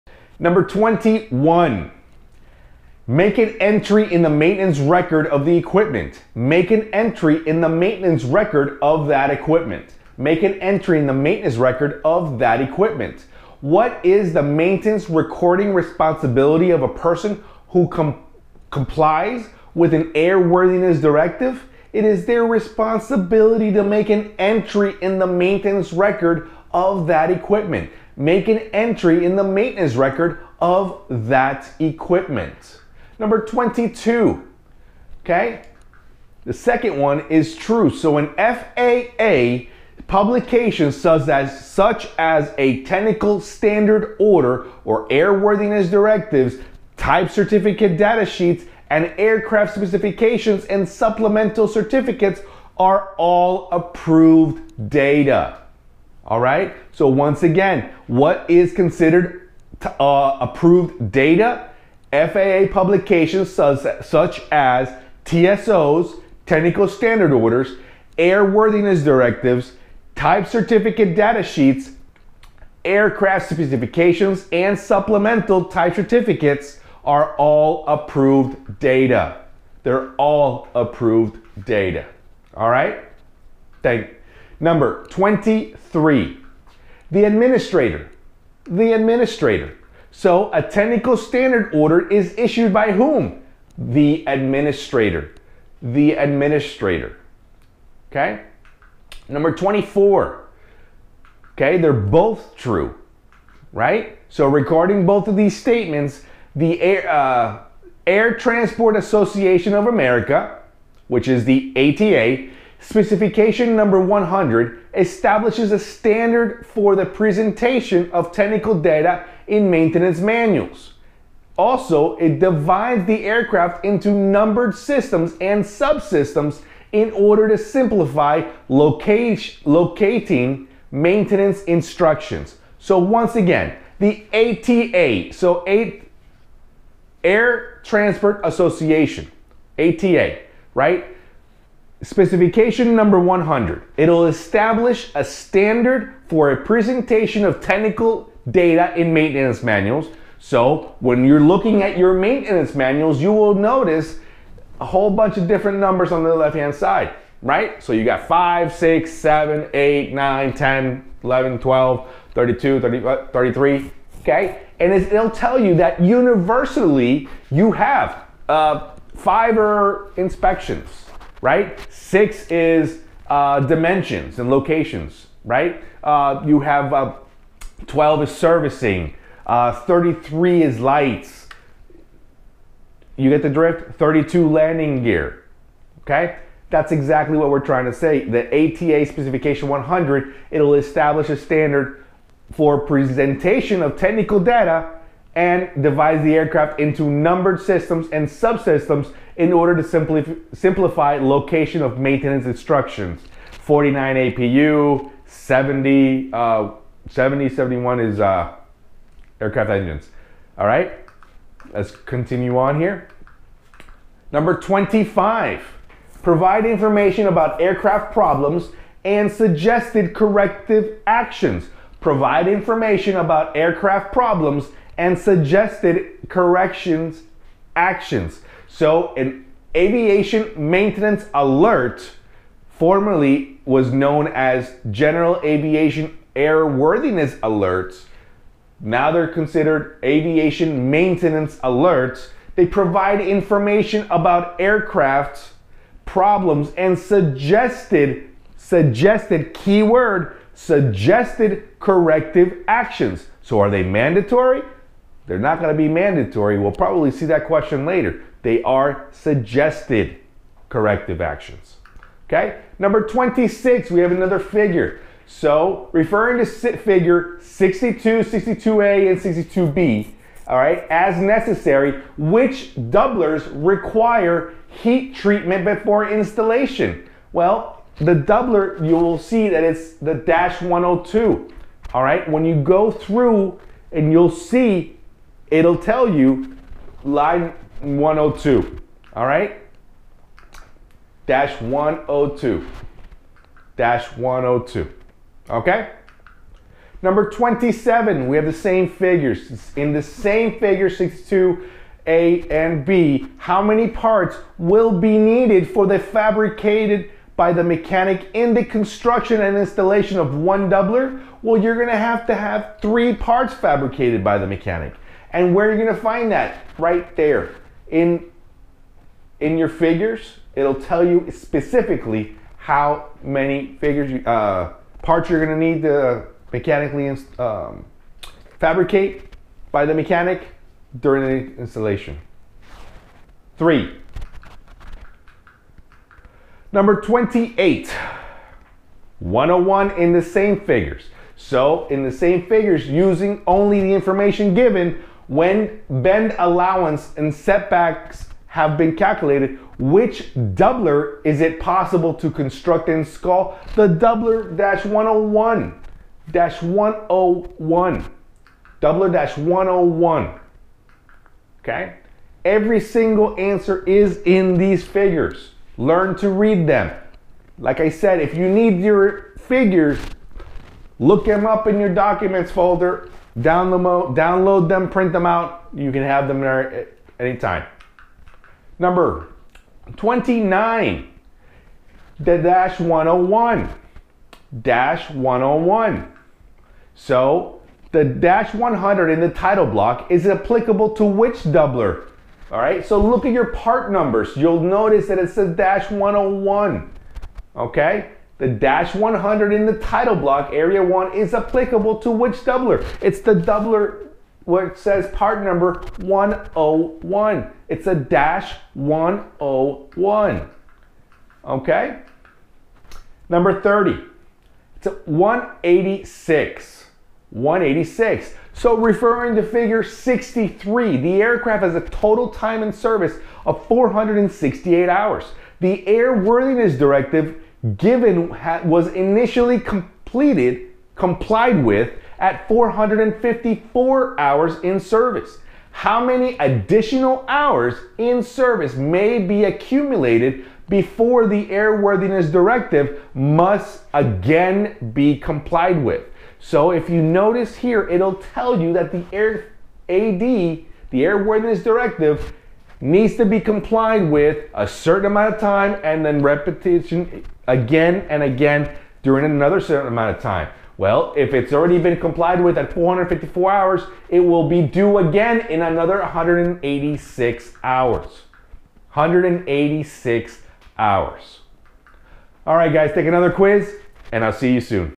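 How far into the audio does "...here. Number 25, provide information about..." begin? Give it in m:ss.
3:32.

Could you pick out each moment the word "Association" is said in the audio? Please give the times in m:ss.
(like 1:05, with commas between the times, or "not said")
1:48, 2:18.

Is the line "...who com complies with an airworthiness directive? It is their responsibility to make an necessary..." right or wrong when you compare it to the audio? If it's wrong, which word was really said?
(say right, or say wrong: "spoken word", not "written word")
wrong: "entry", not "necessary".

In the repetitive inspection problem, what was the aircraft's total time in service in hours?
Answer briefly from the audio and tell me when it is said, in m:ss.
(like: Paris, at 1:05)
468, at 7:03.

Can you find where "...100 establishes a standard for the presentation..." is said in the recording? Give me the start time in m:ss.
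1:54.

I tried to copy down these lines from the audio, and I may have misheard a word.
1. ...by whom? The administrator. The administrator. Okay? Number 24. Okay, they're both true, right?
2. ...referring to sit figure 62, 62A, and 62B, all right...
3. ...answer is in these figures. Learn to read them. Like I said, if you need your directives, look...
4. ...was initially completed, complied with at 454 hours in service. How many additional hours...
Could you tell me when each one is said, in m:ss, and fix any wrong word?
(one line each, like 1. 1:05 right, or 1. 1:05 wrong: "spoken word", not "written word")
1. 1:32 right
2. 4:25 right
3. 6:03 wrong: "figures", not "directives"
4. 7:08 right.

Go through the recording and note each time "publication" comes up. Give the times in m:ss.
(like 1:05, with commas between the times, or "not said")
0:40, 1:02.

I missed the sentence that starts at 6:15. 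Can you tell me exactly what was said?
You can have them there anytime.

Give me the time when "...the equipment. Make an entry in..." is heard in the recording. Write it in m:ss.
0:05.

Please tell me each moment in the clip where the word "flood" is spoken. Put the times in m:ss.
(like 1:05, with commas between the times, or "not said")
not said.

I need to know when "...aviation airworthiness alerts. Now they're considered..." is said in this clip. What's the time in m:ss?
3:55.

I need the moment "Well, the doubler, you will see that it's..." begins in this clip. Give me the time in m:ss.
4:37.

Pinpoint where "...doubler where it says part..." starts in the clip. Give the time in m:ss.
6:43.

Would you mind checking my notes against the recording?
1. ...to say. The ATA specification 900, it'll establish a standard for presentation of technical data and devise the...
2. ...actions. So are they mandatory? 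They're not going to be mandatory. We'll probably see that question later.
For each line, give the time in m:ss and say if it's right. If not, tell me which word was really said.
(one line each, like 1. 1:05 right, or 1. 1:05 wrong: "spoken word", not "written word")
1. 3:07 wrong: "100", not "900"
2. 4:12 right.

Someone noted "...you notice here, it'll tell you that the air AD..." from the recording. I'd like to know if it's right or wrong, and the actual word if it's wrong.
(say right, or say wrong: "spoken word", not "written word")
right.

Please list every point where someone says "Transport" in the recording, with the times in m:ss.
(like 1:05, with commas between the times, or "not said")
1:48, 2:17.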